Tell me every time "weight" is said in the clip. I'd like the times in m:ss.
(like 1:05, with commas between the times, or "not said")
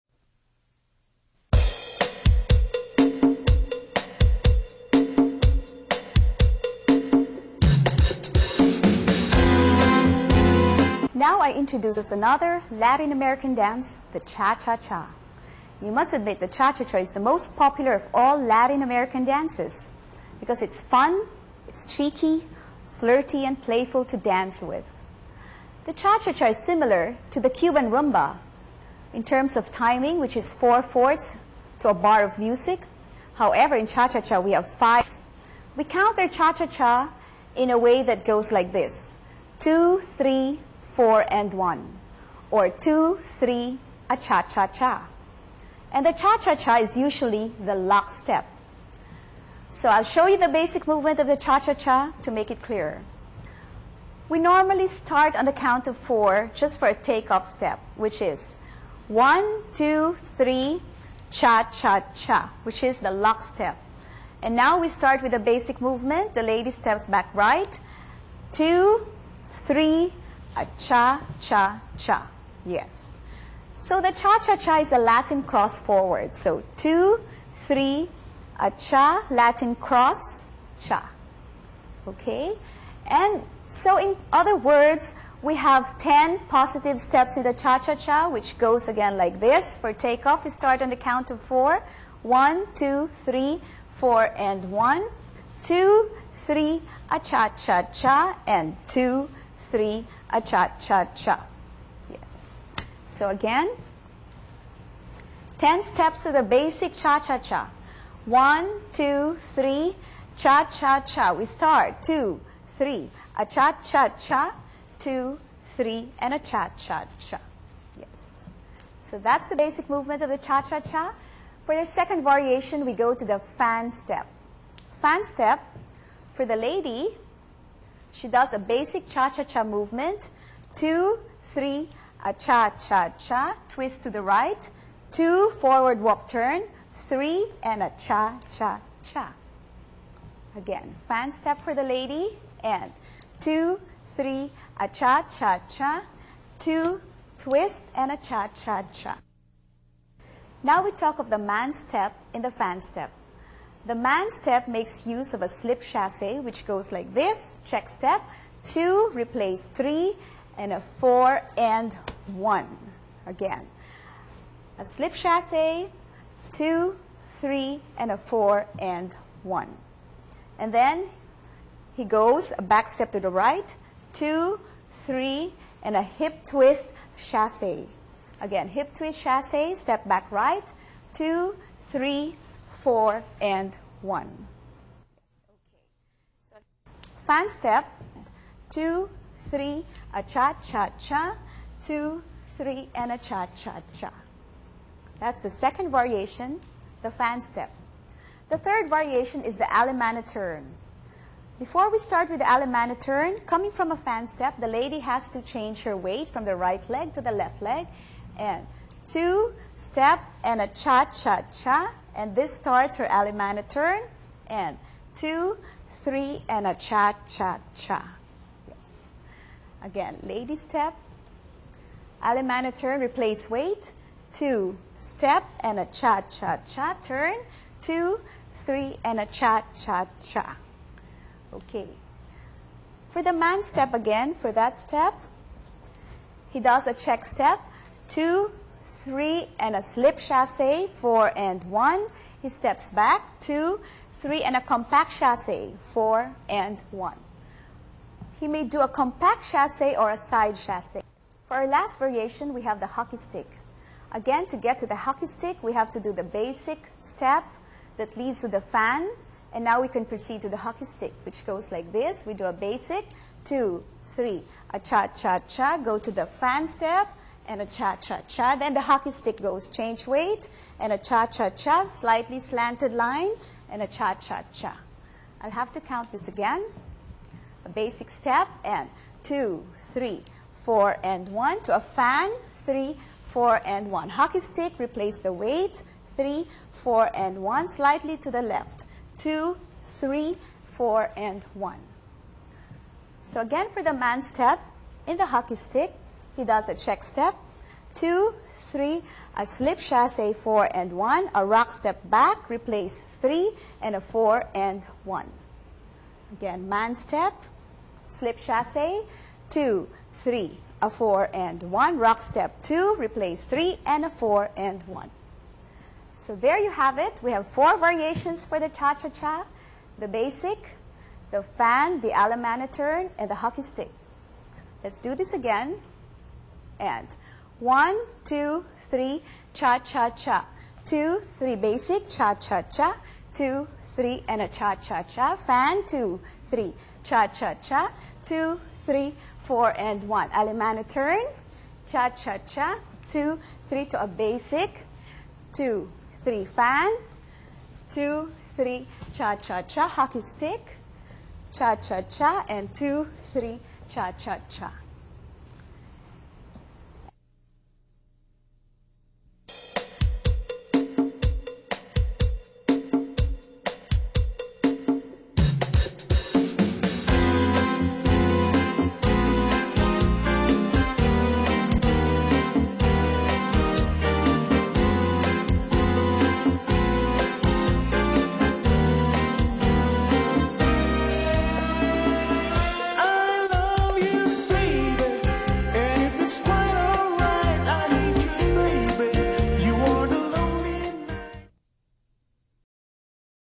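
3:25, 3:43, 4:30, 4:45.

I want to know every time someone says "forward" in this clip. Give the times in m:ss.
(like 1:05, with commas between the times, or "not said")
1:15, 2:15.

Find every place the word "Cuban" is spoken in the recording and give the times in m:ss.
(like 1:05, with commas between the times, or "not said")
0:27.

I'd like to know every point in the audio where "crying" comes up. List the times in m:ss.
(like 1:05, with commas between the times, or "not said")
not said.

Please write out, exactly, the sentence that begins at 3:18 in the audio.
The third variation is the alemana turn.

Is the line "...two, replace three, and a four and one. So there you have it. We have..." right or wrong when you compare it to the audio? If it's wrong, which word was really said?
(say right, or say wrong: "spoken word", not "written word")
right.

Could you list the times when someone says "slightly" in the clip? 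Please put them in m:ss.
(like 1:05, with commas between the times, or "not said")
4:31, 4:47.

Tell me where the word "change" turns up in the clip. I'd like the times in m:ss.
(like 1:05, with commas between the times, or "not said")
3:25, 4:29.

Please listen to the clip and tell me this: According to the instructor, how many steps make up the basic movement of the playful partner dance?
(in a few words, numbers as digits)
10.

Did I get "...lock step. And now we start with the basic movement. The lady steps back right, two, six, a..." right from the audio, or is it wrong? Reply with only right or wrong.
wrong.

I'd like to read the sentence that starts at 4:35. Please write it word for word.
I'll have to count this again.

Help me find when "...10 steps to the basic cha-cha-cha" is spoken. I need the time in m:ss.
1:45.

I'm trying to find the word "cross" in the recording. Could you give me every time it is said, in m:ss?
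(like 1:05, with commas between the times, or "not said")
1:15, 1:19.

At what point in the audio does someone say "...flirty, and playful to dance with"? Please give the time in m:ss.
0:22.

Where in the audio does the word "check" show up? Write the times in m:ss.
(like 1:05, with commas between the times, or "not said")
2:37, 3:56, 4:56.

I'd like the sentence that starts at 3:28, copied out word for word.
And two, step, and a cha-cha-cha.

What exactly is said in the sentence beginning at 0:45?
And the cha-cha-cha is usually the lock step.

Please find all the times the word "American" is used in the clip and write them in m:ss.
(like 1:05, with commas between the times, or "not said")
0:13, 0:18.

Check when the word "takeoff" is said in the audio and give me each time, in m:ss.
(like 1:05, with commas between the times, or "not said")
0:56, 1:29.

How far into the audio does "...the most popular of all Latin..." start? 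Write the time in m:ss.
0:17.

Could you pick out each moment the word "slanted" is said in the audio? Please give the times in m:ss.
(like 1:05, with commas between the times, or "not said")
4:32.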